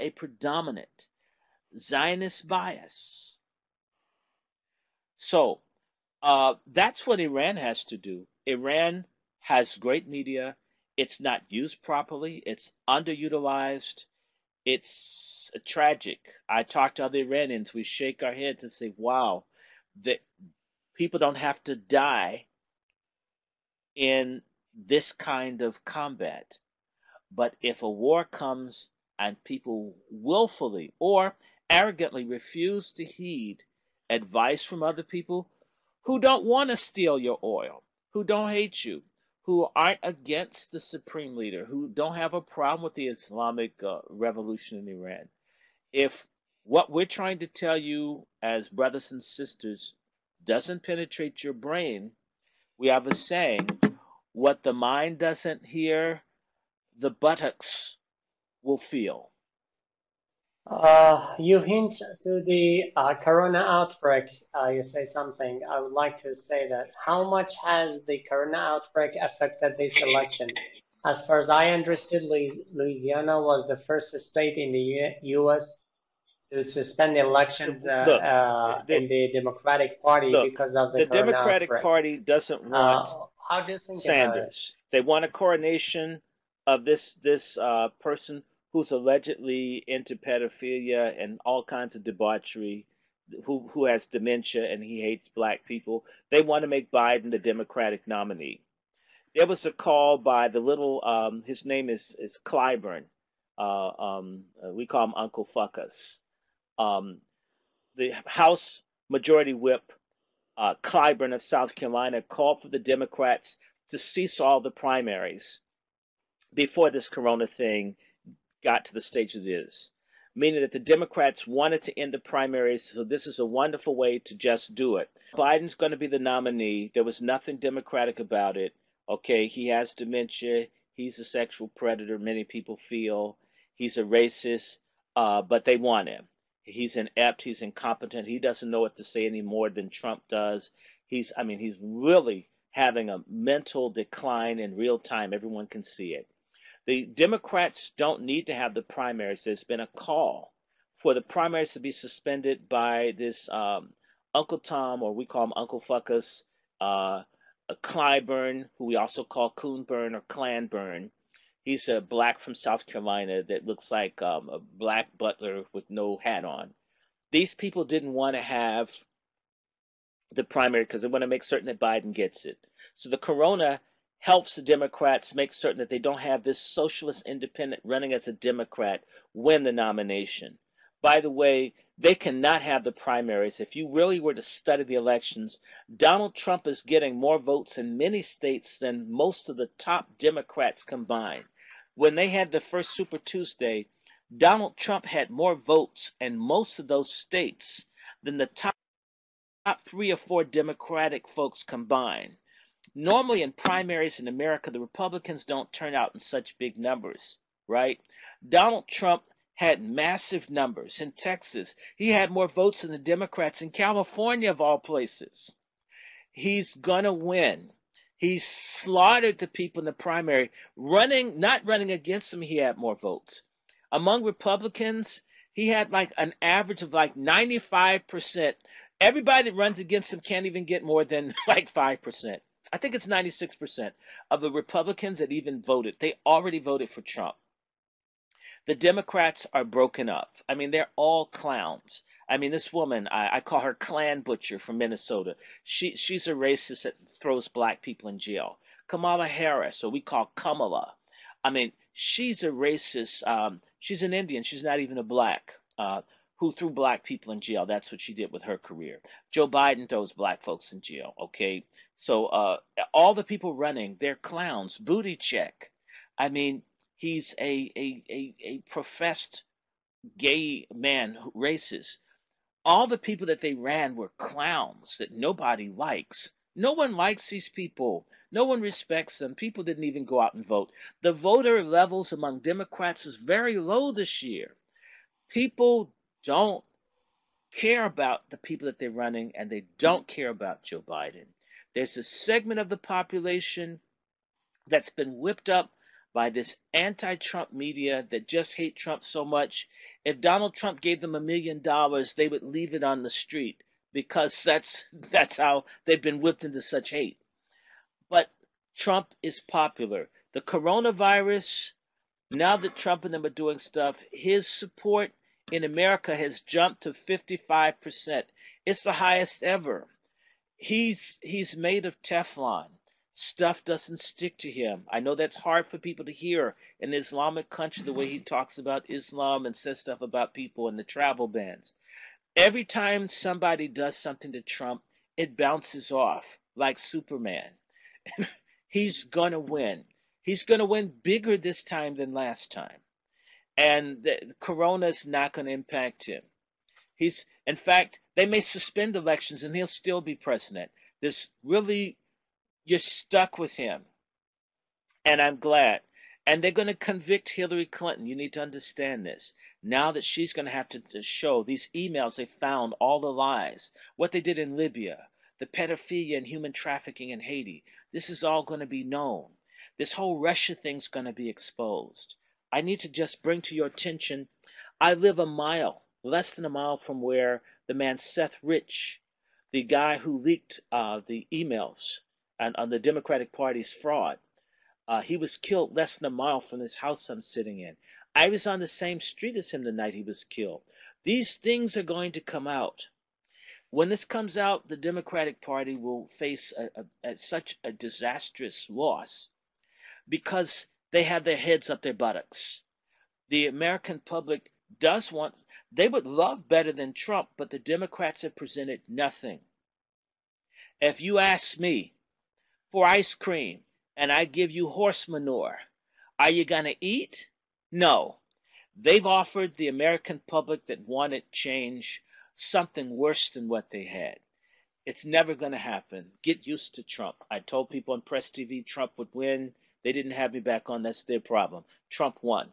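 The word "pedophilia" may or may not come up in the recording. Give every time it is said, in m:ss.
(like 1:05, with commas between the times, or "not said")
1:30, 6:05.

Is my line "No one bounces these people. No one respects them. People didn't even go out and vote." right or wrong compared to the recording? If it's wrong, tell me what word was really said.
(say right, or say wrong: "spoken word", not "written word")
wrong: "likes", not "bounces".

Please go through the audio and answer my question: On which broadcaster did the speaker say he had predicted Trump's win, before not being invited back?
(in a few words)
Press TV.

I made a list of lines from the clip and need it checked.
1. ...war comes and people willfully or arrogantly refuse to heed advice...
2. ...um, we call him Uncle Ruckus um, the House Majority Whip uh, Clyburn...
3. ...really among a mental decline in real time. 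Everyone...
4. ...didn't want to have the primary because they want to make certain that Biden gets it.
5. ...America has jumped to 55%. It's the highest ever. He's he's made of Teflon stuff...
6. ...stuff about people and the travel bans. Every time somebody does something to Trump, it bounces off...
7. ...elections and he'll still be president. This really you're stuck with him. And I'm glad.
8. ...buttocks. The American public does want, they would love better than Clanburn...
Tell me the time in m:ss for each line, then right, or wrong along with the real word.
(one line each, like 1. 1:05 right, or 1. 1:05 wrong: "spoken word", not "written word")
1. 0:27 right
2. 1:43 right
3. 2:21 wrong: "having", not "among"
4. 2:47 right
5. 5:15 right
6. 5:29 right
7. 5:48 right
8. 6:41 wrong: "Trump", not "Clanburn".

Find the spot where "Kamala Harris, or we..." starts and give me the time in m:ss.
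4:08.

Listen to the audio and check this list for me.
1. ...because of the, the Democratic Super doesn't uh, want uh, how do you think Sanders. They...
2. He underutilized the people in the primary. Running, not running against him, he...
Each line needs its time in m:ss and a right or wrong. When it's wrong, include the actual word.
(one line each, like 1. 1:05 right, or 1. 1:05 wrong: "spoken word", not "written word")
1. 1:20 wrong: "Party", not "Super"
2. 3:38 wrong: "slaughtered", not "underutilized".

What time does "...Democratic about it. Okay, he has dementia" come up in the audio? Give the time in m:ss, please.
2:07.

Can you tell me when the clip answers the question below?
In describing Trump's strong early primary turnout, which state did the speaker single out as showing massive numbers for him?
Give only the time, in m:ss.
3:31.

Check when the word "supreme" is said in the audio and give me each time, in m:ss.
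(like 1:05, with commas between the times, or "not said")
0:40.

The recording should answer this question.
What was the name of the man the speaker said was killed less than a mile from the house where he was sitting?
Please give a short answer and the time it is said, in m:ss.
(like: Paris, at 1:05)
Seth Rich, at 6:17.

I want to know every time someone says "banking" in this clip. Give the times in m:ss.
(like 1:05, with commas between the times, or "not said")
not said.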